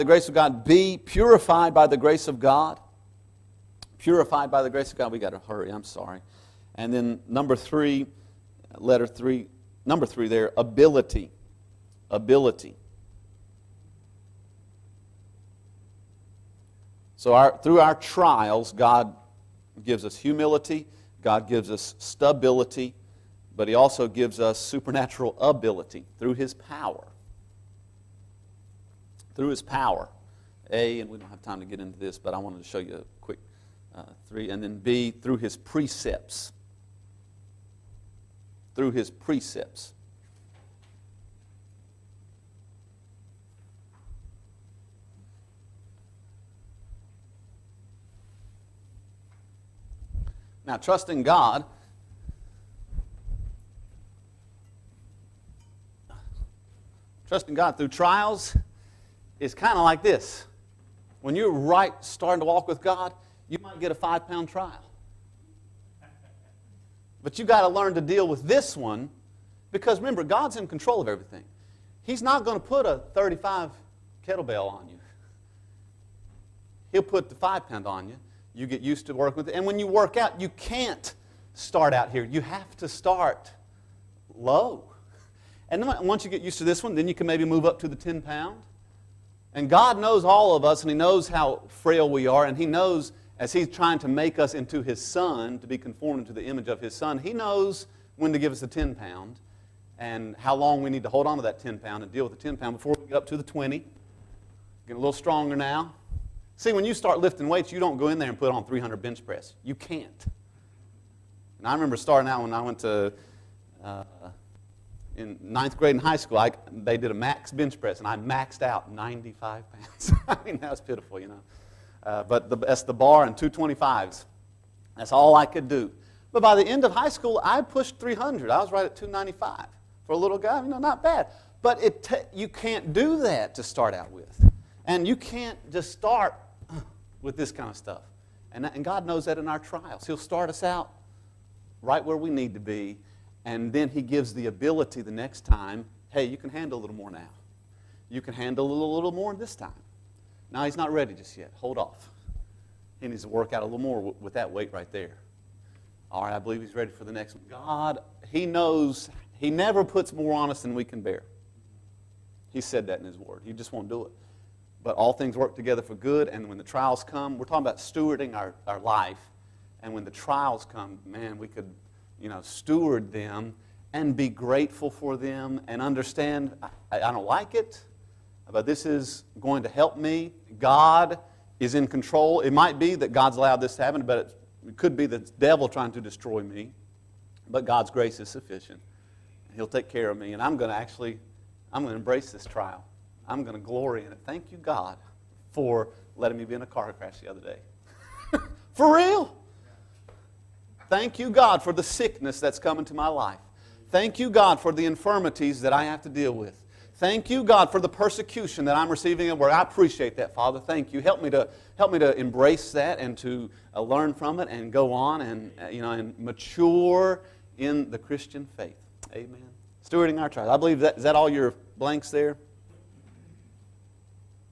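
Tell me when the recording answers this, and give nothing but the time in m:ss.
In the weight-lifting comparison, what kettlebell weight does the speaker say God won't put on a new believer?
1:13.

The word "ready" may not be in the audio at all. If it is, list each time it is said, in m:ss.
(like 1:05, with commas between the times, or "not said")
2:30, 2:36.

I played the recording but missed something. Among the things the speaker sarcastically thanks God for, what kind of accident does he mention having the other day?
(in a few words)
car crash.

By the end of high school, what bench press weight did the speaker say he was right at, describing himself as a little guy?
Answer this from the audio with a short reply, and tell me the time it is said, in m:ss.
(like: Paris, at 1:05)
295, at 2:08.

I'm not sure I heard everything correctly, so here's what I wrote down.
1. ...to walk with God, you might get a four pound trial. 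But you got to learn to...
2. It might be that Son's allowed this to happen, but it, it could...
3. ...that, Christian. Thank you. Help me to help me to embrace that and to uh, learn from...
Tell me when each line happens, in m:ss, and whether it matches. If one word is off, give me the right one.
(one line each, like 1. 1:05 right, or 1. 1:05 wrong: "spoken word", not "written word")
1. 1:02 wrong: "five", not "four"
2. 3:02 wrong: "God", not "Son"
3. 3:30 wrong: "Father", not "Christian".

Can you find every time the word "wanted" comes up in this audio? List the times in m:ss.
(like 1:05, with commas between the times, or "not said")
0:32.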